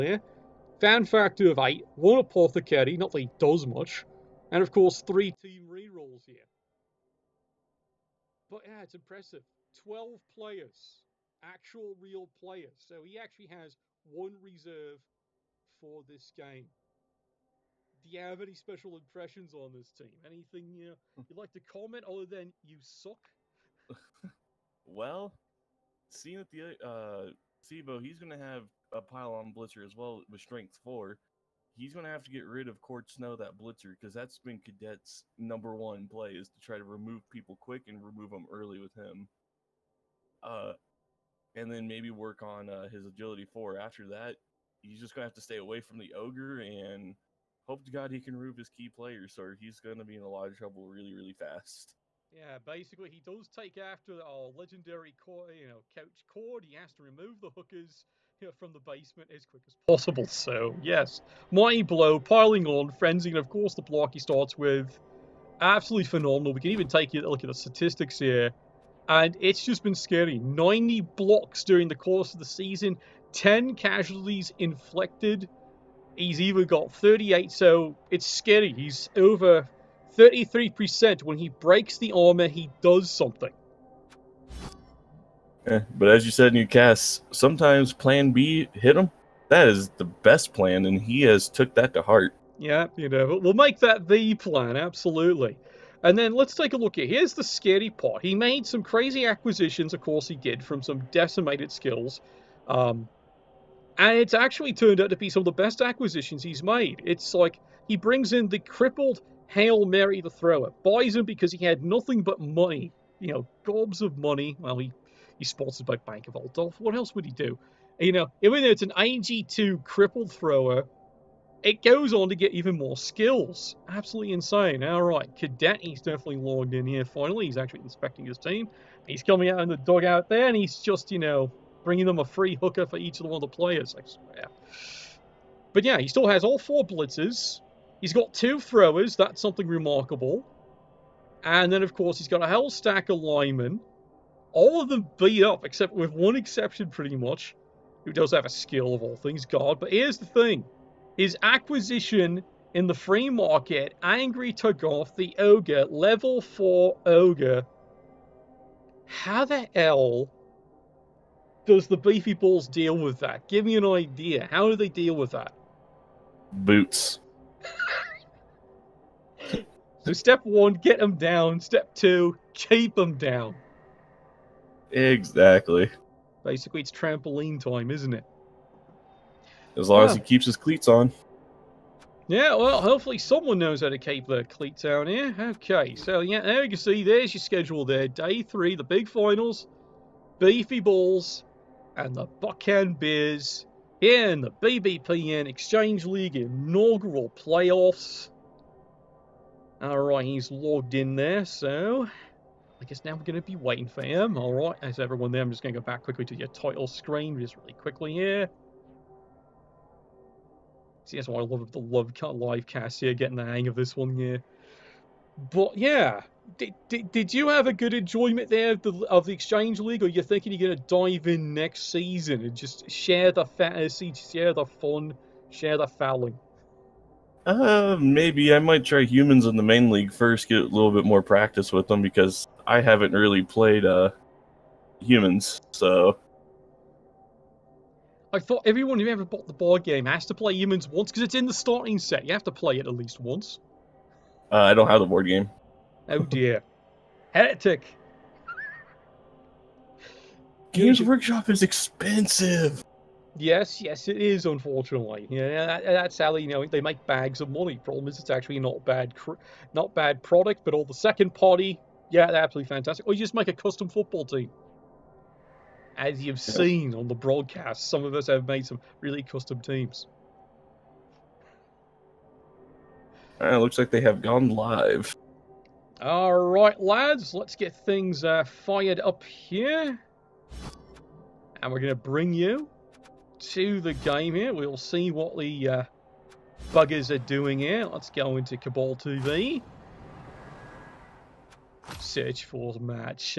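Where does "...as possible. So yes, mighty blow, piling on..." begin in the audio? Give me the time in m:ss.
0:59.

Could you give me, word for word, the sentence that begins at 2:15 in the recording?
But yeah, he still has all four blitzers.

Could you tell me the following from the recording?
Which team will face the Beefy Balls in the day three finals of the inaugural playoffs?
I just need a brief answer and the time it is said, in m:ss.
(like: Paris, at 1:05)
Buc-Can Bears, at 3:12.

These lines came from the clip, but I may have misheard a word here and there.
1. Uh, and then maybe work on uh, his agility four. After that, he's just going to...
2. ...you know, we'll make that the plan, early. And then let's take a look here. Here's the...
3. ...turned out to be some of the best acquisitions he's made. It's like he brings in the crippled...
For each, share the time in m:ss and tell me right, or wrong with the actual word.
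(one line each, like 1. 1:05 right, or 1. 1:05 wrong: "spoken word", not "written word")
1. 0:40 right
2. 1:32 wrong: "absolutely", not "early"
3. 1:44 right.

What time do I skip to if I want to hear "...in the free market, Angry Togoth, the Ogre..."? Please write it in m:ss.
2:32.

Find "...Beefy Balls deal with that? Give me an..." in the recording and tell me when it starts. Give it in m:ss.
2:41.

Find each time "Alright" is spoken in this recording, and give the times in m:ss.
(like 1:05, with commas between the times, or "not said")
3:19, 3:24.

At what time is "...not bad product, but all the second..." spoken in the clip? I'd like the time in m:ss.
4:19.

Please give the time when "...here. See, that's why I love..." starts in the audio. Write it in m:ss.
3:28.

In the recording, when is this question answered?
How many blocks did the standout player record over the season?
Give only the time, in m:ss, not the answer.
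1:10.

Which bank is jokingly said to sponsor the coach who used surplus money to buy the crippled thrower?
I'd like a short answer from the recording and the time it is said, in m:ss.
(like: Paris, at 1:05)
Bank of Altdorf, at 1:55.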